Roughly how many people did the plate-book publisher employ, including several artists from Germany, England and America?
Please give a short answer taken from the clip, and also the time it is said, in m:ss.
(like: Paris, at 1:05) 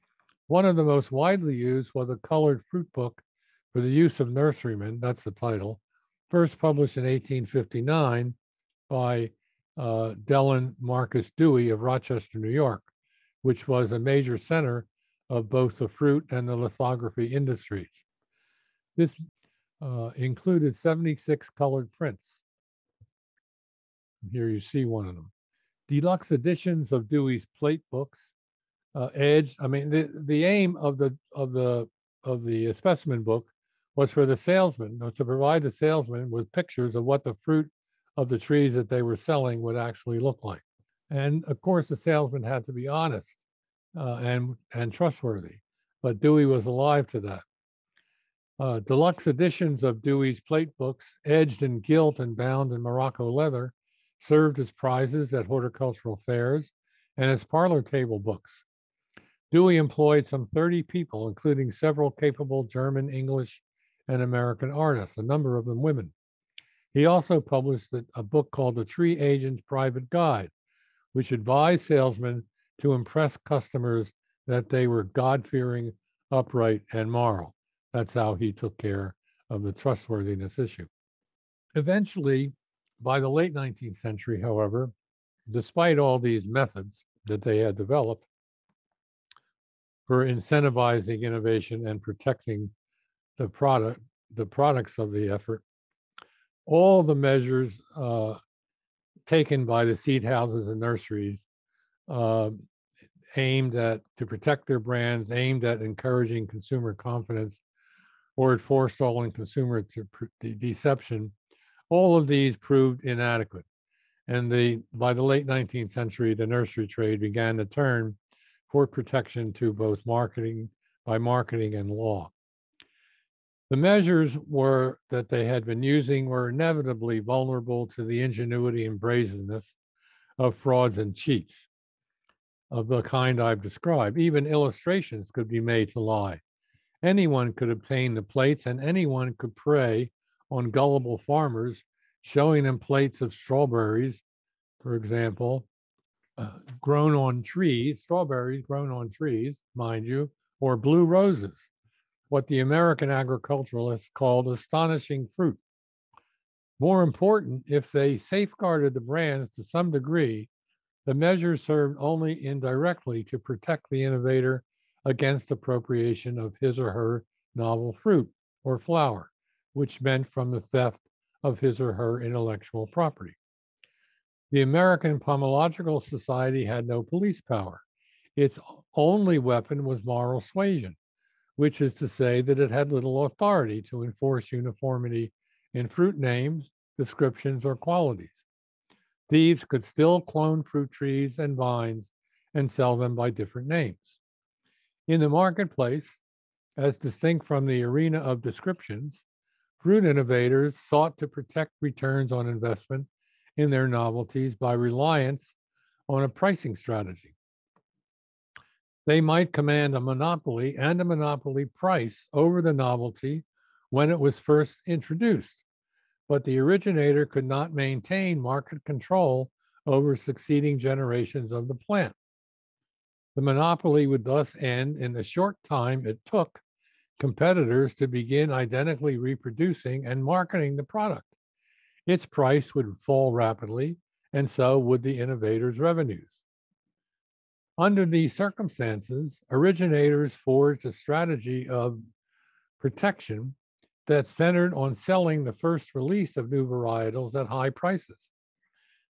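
30, at 1:00.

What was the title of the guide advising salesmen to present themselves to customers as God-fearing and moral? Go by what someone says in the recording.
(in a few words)
The Tree Agent's Private Guide.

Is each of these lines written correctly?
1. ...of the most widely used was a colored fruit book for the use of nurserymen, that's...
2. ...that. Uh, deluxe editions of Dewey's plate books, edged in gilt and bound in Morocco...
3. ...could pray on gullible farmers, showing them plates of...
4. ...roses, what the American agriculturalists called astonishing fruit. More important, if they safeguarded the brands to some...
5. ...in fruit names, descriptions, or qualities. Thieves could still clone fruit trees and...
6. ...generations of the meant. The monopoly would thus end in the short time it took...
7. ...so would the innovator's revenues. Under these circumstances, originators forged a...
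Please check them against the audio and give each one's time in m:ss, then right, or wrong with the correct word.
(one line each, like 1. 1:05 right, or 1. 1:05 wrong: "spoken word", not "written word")
1. 0:00 right
2. 0:47 right
3. 2:19 right
4. 2:31 right
5. 3:05 right
6. 3:40 wrong: "plant", not "meant"
7. 3:54 right.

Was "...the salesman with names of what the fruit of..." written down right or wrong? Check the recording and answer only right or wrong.
wrong.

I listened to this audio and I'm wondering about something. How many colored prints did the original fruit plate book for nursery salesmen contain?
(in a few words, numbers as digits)
76.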